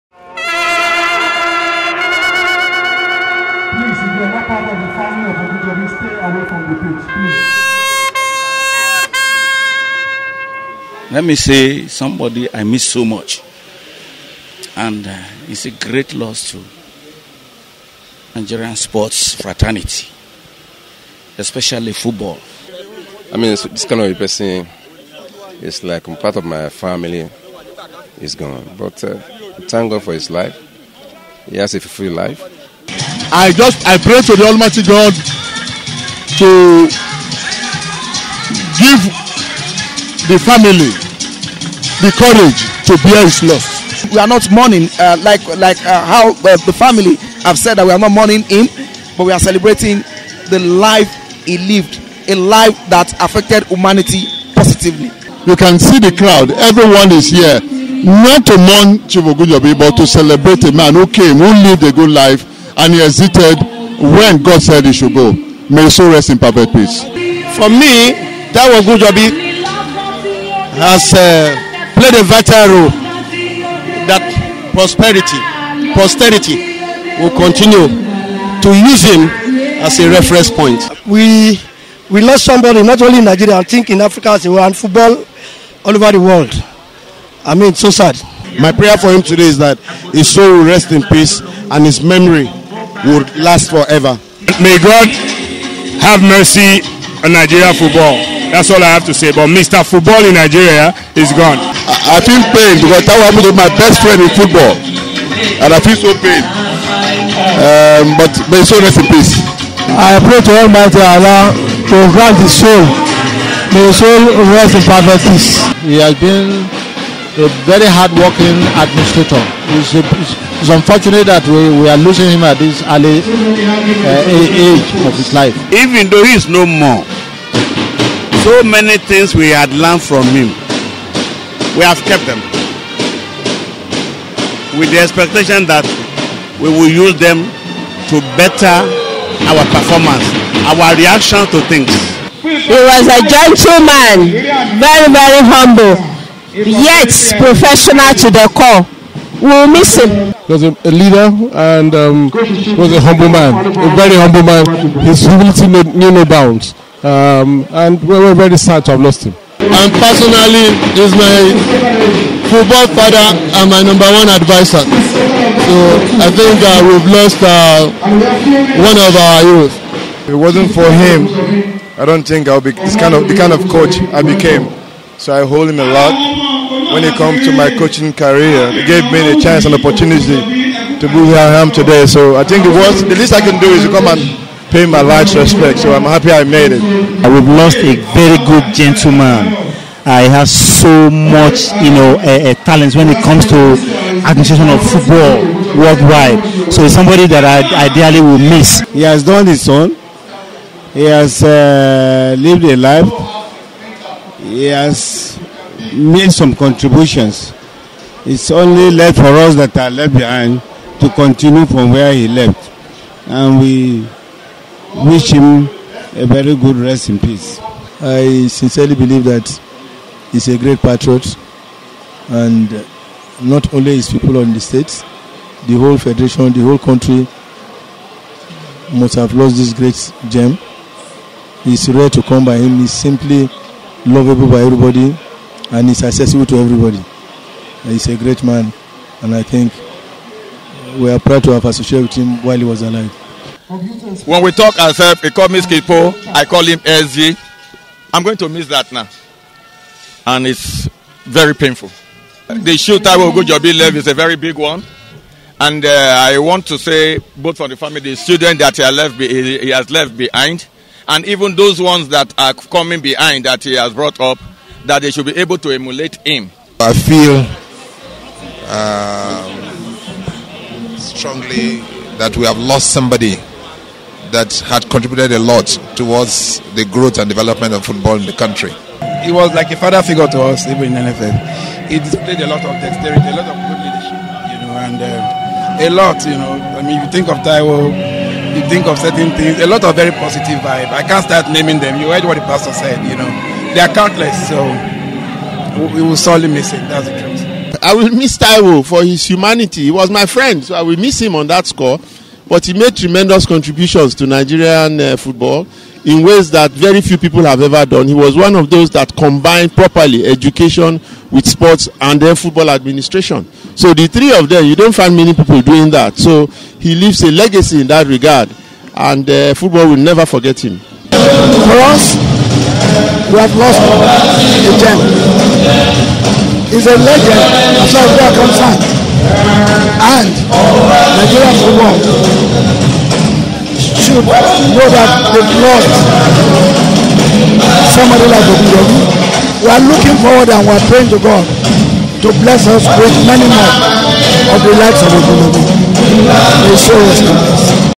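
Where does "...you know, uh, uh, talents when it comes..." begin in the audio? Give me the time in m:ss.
3:11.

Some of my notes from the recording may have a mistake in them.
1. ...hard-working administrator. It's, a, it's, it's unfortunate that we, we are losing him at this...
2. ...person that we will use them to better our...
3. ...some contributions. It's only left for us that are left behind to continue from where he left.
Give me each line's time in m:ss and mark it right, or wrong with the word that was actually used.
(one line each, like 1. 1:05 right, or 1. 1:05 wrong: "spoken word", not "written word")
1. 1:57 right
2. 2:14 wrong: "expectation", not "person"
3. 3:26 right.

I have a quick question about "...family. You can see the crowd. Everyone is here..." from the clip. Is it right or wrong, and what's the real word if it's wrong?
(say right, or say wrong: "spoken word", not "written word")
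wrong: "positively", not "family".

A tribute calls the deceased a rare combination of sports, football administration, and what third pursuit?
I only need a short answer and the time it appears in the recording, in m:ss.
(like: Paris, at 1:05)
education, at 5:10.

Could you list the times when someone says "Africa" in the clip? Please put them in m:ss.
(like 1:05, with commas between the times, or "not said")
1:24.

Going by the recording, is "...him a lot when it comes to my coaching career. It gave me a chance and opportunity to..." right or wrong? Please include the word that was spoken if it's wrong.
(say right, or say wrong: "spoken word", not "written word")
right.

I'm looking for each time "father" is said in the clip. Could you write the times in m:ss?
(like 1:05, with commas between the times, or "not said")
2:42, 4:39.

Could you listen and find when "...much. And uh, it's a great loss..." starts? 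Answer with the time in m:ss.
0:13.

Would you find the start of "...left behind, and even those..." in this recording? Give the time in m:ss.
4:19.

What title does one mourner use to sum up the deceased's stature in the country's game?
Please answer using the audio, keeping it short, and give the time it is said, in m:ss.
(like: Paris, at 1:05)
Mr. Football, at 1:39.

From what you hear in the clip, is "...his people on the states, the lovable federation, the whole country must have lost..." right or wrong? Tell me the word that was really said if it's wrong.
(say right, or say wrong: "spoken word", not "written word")
wrong: "whole", not "lovable".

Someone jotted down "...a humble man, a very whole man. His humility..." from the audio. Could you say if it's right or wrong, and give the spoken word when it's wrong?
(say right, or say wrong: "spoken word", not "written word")
wrong: "humble", not "whole".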